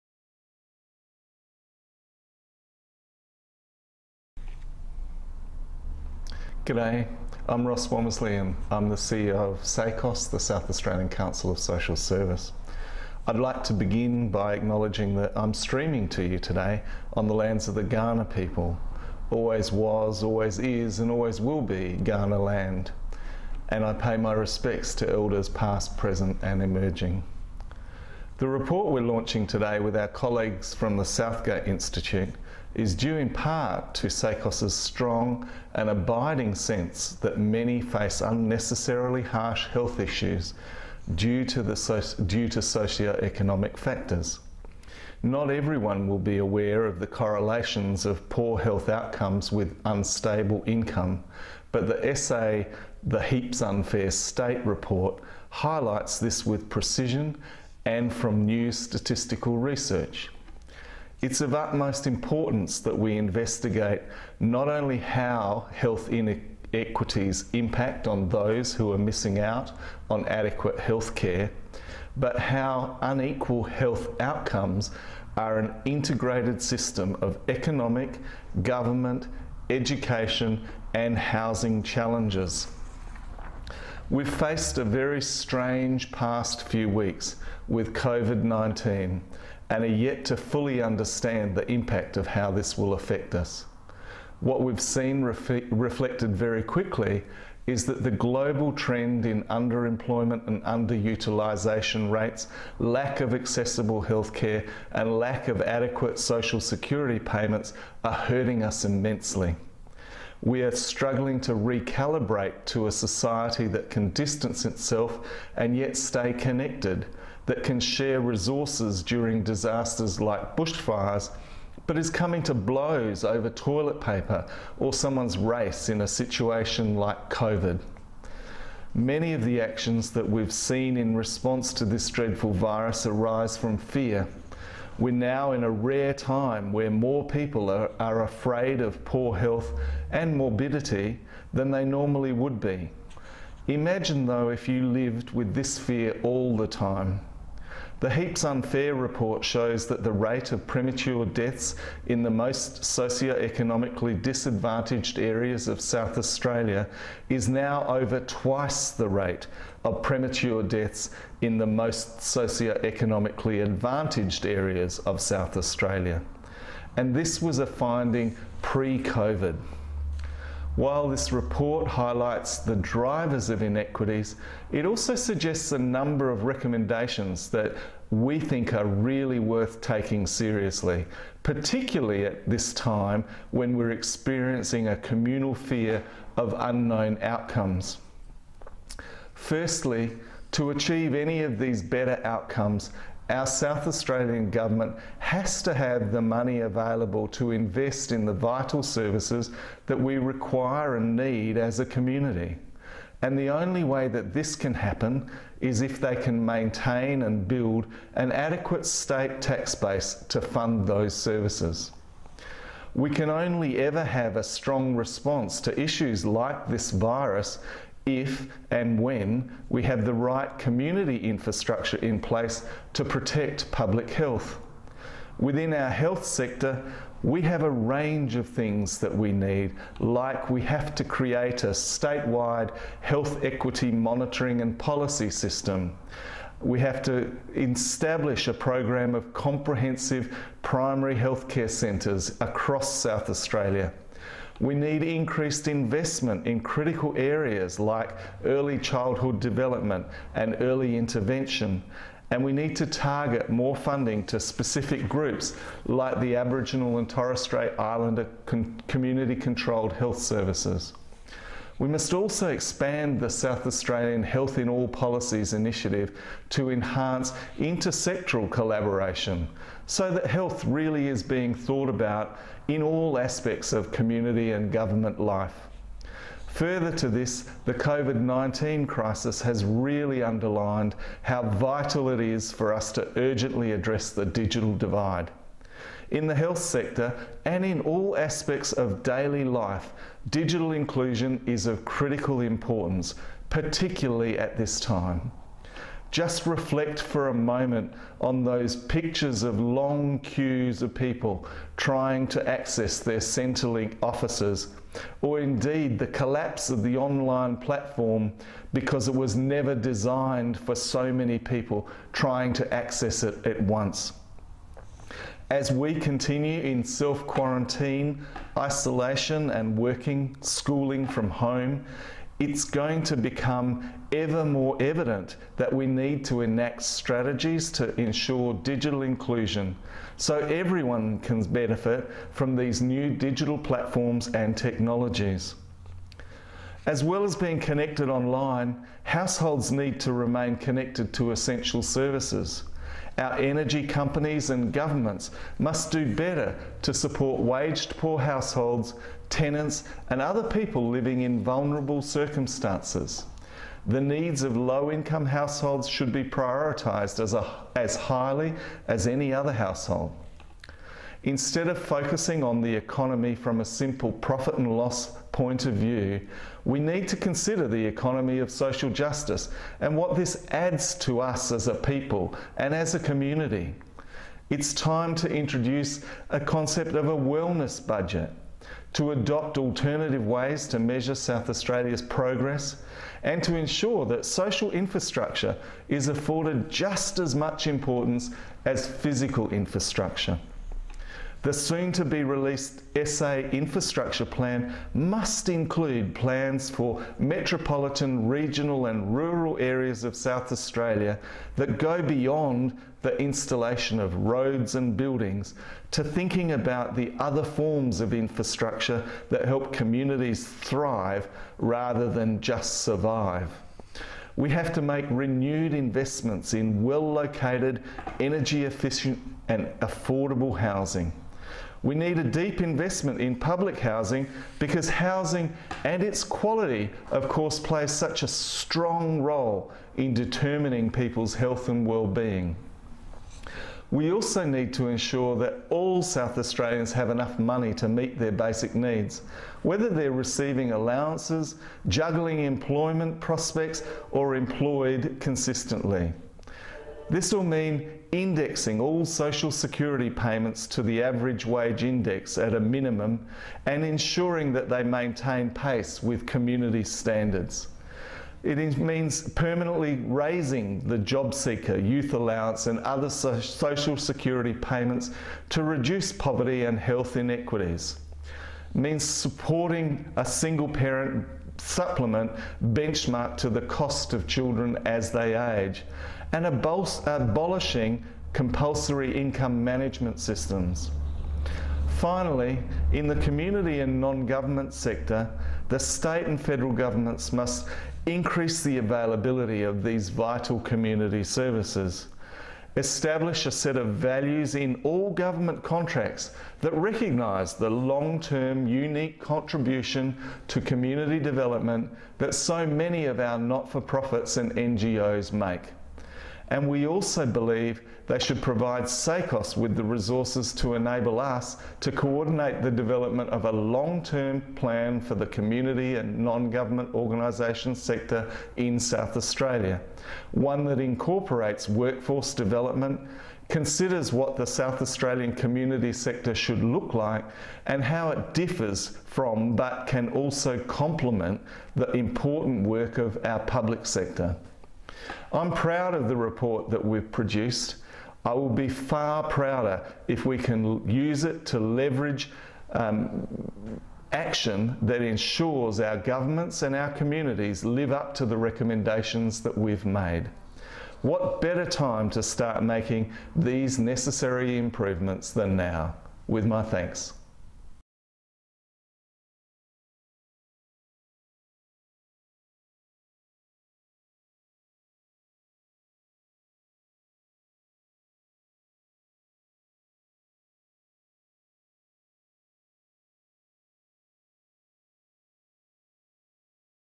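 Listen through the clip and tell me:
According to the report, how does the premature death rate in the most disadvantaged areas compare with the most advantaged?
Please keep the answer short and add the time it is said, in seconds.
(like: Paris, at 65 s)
Over twice, at 157 s.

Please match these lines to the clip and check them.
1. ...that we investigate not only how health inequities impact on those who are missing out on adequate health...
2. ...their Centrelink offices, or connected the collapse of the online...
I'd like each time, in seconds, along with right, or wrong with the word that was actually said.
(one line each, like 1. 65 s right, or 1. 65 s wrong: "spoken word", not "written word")
1. 62 s right
2. 302 s wrong: "indeed", not "connected".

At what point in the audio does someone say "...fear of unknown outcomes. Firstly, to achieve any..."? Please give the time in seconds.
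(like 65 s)
185 s.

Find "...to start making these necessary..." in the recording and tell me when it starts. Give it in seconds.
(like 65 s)
552 s.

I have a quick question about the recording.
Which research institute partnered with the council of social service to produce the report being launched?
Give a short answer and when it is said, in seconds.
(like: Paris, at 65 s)
Southgate Institute, at 31 s.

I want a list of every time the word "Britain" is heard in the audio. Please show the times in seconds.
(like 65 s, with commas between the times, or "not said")
not said.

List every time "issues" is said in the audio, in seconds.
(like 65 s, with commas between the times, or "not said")
39 s, 215 s.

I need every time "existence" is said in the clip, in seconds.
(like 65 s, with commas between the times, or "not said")
not said.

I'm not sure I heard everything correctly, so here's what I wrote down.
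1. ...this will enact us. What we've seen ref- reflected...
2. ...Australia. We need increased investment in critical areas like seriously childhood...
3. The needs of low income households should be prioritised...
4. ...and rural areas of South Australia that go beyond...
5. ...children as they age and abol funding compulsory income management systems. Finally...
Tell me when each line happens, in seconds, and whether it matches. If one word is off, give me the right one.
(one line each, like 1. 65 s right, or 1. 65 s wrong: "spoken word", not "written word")
1. 92 s wrong: "affect", not "enact"
2. 243 s wrong: "early", not "seriously"
3. 353 s right
4. 398 s right
5. 474 s wrong: "abolishing", not "funding".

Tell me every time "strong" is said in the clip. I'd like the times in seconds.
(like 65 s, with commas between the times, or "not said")
34 s, 214 s, 428 s.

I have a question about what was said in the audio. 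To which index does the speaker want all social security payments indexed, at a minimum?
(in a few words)
Average wage index.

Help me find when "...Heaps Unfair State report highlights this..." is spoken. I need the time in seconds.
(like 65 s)
53 s.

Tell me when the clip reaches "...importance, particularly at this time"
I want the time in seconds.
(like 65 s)
292 s.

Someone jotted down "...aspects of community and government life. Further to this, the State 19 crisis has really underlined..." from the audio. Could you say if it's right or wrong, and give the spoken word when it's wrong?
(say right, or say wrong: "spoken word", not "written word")
wrong: "COVID", not "State".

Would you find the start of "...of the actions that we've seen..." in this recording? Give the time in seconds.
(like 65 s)
129 s.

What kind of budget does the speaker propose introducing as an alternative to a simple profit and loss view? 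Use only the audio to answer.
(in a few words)
Wellness budget.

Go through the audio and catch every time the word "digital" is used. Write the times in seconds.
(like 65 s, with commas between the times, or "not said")
284 s, 290 s, 328 s, 333 s.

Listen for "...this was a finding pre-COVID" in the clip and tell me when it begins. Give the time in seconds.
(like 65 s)
167 s.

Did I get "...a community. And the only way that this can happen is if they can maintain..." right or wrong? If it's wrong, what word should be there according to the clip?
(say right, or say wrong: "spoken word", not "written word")
right.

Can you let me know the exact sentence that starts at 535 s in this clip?
I'm proud of the report that we've produced.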